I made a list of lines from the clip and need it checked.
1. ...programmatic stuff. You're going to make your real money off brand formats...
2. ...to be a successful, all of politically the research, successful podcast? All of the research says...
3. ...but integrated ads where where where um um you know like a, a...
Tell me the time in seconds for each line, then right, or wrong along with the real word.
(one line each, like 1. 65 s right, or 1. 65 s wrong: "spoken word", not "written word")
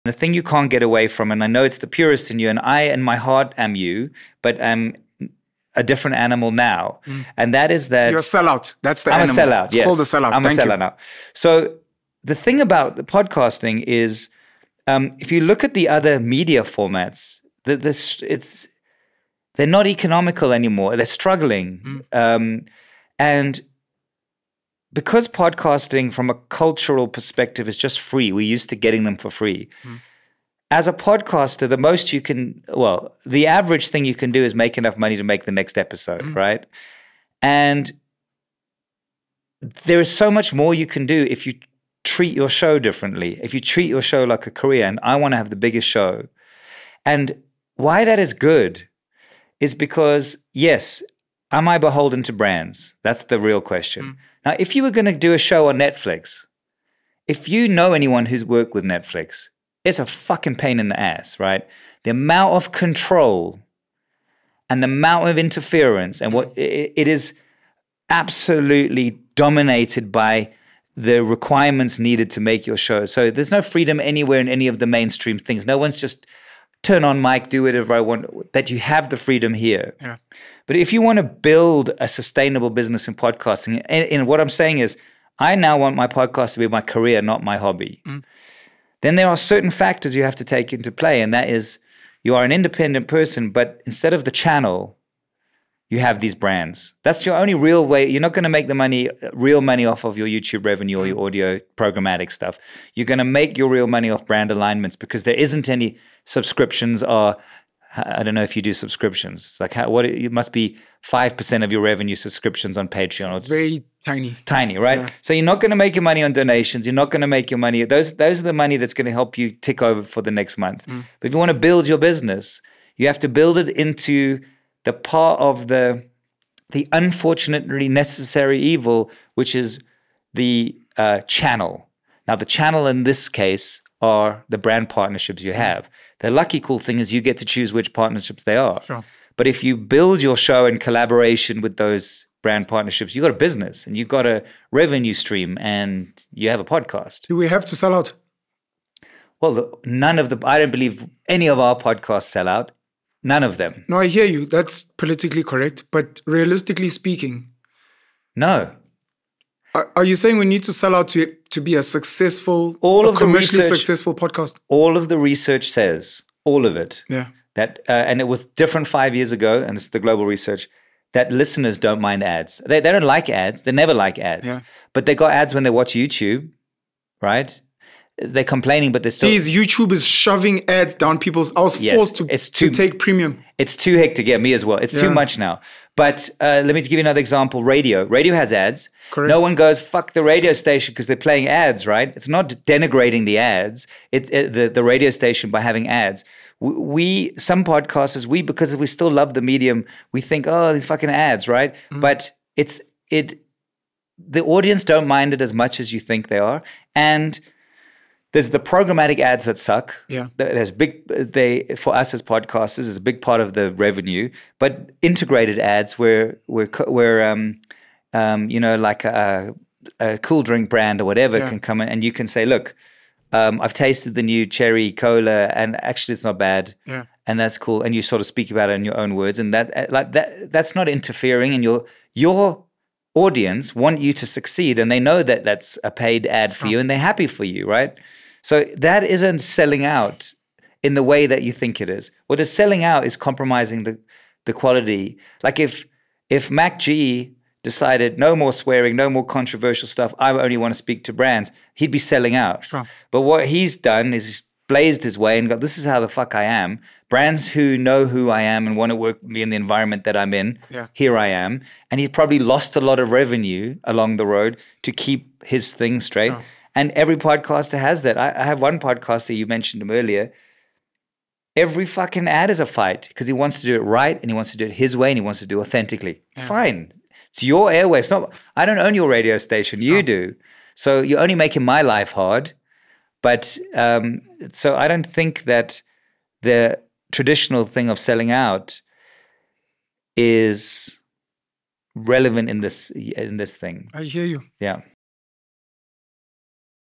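1. 101 s wrong: "alignments", not "formats"
2. 161 s wrong: "commercially", not "politically"
3. 214 s right.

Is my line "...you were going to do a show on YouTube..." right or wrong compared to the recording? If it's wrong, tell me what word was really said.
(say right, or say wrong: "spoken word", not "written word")
wrong: "Netflix", not "YouTube".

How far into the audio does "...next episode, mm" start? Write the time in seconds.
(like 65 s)
35 s.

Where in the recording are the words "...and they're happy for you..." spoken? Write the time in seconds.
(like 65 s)
236 s.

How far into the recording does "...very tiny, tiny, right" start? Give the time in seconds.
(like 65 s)
113 s.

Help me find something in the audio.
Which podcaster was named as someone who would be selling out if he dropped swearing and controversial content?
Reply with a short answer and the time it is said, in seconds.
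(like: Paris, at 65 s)
Mac G, at 246 s.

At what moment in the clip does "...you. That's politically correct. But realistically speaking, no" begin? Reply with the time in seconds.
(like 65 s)
154 s.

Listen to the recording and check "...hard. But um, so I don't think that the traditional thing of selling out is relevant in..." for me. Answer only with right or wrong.
right.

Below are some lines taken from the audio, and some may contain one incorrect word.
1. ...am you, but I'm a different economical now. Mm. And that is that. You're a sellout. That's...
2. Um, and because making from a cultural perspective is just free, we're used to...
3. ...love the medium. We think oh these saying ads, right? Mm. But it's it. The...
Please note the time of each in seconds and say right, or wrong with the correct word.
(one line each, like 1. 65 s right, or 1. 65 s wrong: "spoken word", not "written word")
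1. 3 s wrong: "animal", not "economical"
2. 22 s wrong: "podcasting", not "making"
3. 199 s wrong: "fucking", not "saying".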